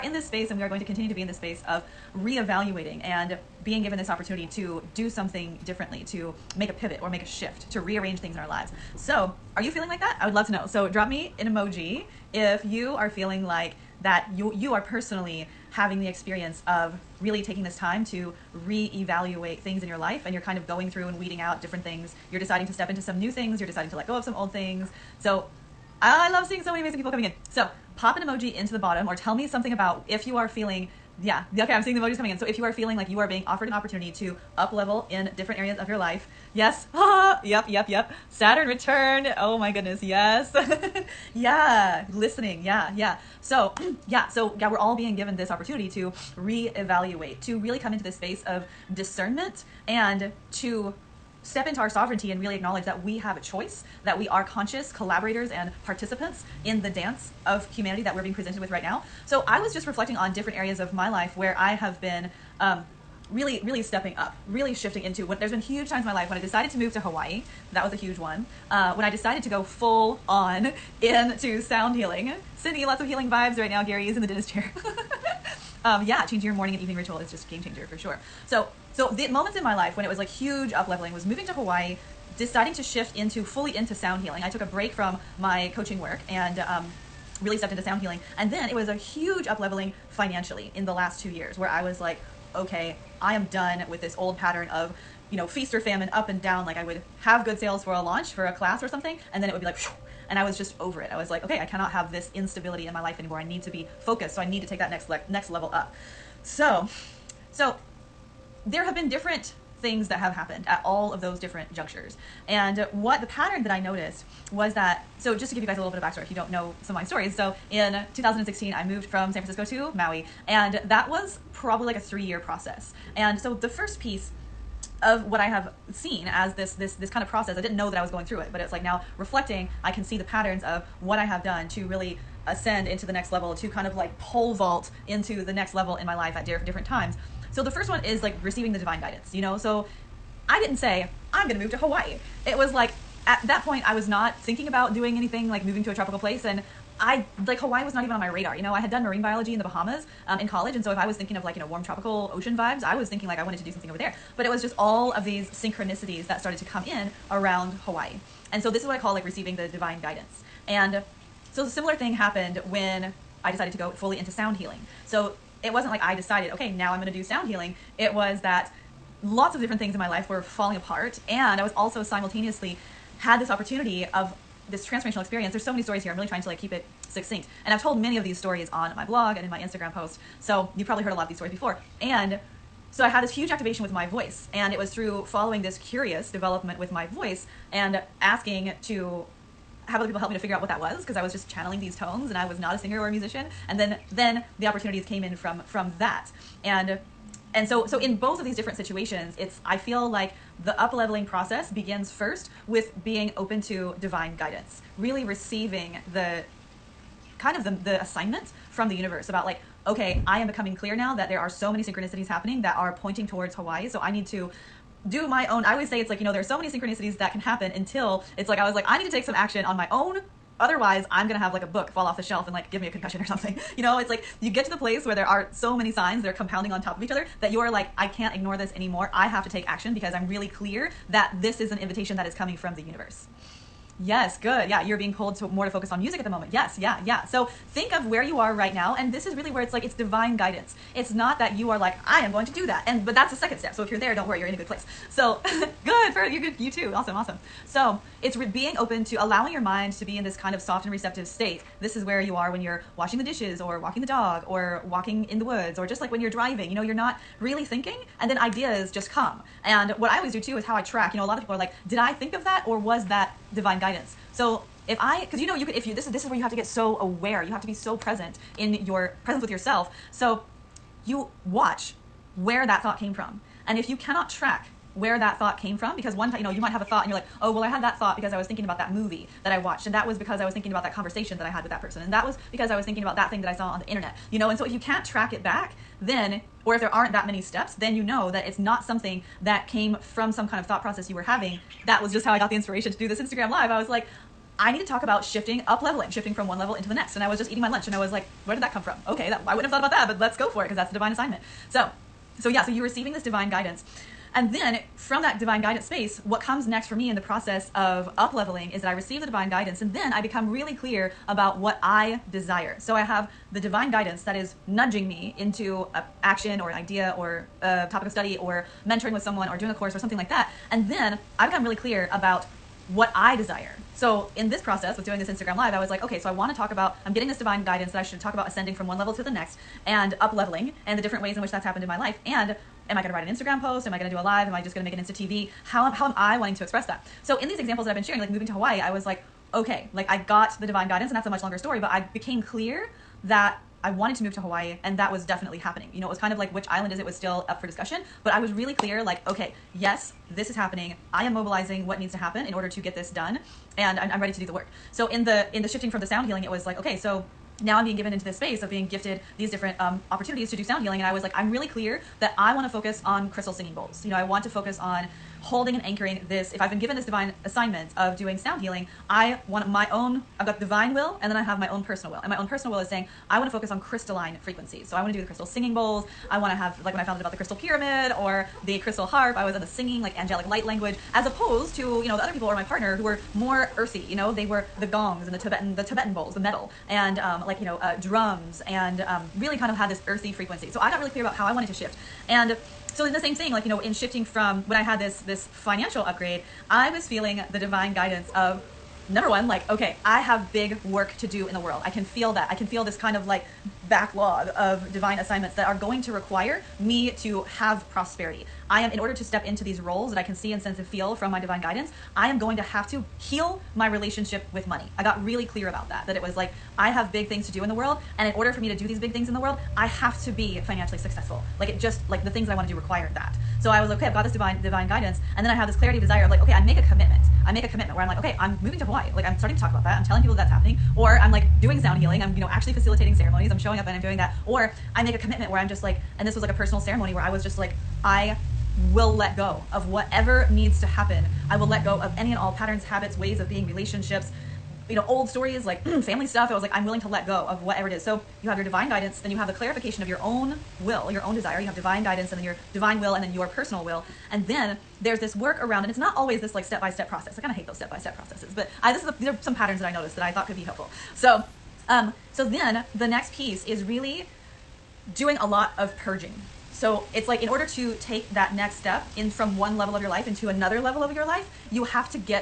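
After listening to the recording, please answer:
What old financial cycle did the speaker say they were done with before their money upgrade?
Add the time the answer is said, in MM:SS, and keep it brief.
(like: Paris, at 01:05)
feast or famine, at 01:35.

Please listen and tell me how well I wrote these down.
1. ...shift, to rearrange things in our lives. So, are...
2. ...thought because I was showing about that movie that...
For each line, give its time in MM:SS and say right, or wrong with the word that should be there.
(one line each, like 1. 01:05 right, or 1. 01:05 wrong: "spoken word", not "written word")
1. 00:07 right
2. 04:37 wrong: "thinking", not "showing".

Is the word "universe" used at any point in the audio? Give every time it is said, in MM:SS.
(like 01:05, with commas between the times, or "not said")
03:28, 03:52.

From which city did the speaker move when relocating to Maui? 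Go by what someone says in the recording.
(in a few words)
San Francisco.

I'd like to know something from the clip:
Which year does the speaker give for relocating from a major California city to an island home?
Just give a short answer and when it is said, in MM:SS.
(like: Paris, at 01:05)
2016, at 01:58.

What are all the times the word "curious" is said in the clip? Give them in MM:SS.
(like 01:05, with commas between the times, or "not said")
03:05.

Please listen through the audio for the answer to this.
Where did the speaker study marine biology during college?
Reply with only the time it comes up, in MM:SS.
02:29.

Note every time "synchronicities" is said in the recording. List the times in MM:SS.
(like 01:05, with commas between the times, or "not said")
02:35, 03:31, 03:36.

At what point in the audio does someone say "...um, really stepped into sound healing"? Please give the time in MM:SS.
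01:26.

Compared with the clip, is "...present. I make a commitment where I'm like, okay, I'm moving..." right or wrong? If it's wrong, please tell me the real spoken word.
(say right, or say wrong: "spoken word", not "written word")
wrong: "commitment", not "present".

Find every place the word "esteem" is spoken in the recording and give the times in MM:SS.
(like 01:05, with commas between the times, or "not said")
not said.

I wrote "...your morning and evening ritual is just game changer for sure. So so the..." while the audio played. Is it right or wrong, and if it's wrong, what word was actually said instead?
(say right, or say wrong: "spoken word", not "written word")
right.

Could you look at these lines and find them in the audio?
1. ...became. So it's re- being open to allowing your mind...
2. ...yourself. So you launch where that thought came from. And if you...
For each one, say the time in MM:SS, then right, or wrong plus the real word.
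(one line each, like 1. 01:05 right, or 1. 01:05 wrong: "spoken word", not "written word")
1. 04:07 wrong: "awesome", not "became"
2. 04:29 wrong: "watch", not "launch".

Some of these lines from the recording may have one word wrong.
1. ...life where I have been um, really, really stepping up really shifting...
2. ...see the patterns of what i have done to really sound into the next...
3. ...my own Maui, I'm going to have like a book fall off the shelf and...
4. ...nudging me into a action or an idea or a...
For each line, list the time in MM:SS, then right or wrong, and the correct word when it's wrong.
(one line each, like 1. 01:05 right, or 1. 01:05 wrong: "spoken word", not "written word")
1. 01:01 right
2. 02:10 wrong: "ascend", not "sound"
3. 03:39 wrong: "Otherwise", not "Maui"
4. 05:14 right.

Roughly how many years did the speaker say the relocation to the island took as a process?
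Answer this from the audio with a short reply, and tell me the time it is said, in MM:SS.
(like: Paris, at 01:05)
3, at 02:01.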